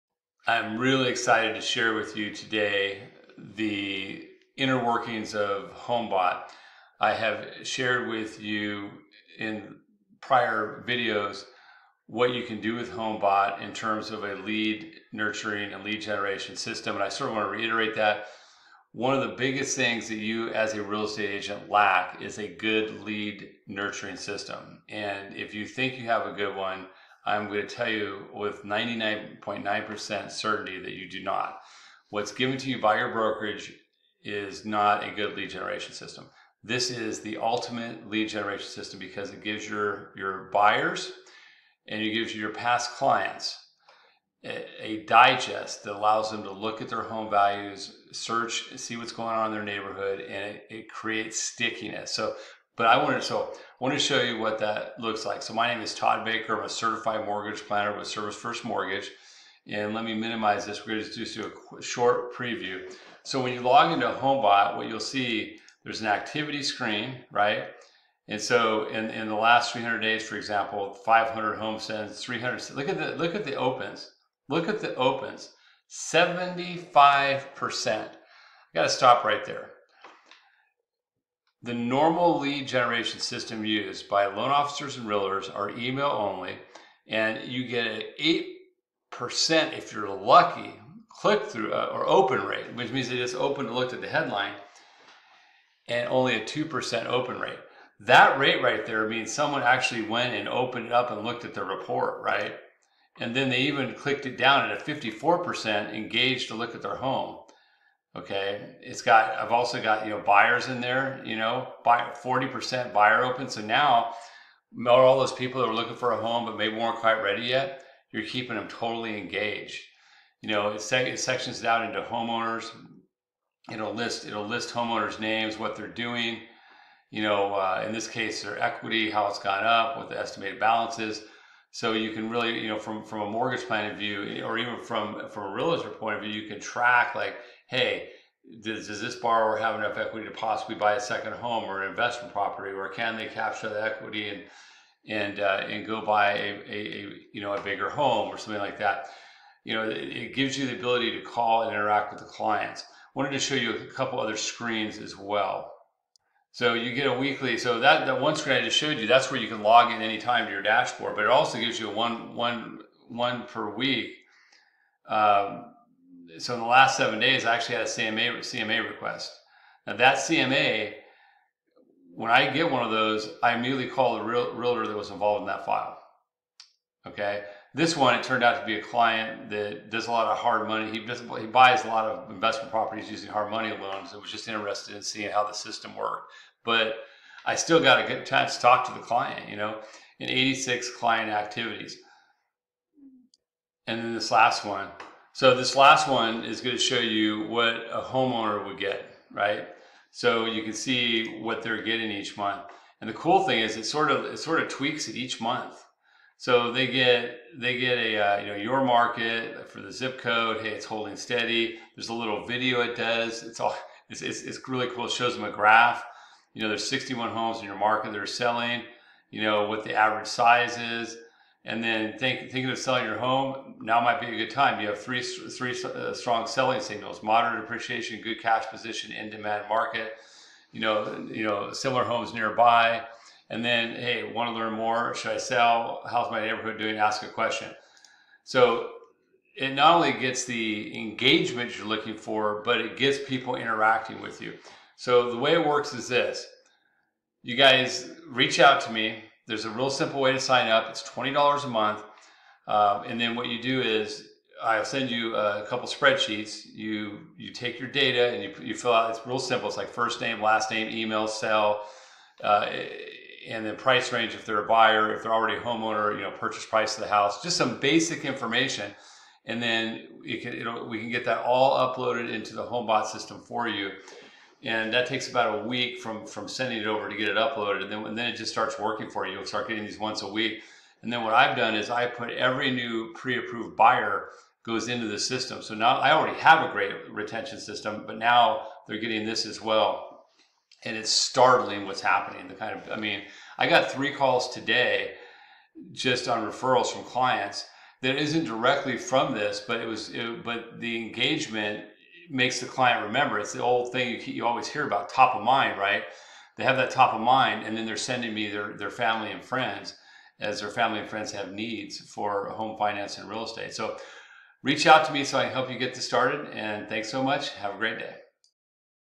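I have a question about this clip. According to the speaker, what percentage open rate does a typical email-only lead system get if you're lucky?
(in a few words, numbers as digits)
8%.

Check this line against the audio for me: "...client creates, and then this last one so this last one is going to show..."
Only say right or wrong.
wrong.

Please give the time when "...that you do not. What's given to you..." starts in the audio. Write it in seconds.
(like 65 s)
30 s.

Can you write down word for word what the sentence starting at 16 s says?
And I sort of want to reiterate that.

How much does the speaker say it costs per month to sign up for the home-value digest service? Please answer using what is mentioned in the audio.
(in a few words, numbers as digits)
$20.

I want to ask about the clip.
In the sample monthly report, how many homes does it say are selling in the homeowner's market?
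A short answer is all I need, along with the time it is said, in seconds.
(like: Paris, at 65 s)
61, at 216 s.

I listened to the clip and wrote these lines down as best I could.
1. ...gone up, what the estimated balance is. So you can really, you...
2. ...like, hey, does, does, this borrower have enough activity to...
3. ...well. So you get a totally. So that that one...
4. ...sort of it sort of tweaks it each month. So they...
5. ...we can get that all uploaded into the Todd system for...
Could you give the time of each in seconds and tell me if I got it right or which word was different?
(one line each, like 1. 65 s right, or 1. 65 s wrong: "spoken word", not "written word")
1. 129 s right
2. 137 s wrong: "equity", not "activity"
3. 155 s wrong: "weekly", not "totally"
4. 203 s right
5. 270 s wrong: "HomeBot", not "Todd".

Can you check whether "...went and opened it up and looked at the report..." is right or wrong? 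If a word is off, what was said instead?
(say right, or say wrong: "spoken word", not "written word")
right.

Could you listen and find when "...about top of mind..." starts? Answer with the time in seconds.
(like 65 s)
304 s.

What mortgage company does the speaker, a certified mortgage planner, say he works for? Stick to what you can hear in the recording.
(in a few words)
Service First Mortgage.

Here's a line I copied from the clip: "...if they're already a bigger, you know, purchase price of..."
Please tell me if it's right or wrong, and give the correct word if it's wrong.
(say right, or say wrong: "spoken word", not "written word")
wrong: "homeowner", not "bigger".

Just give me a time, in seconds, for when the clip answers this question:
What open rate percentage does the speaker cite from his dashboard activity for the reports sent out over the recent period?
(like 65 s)
75 s.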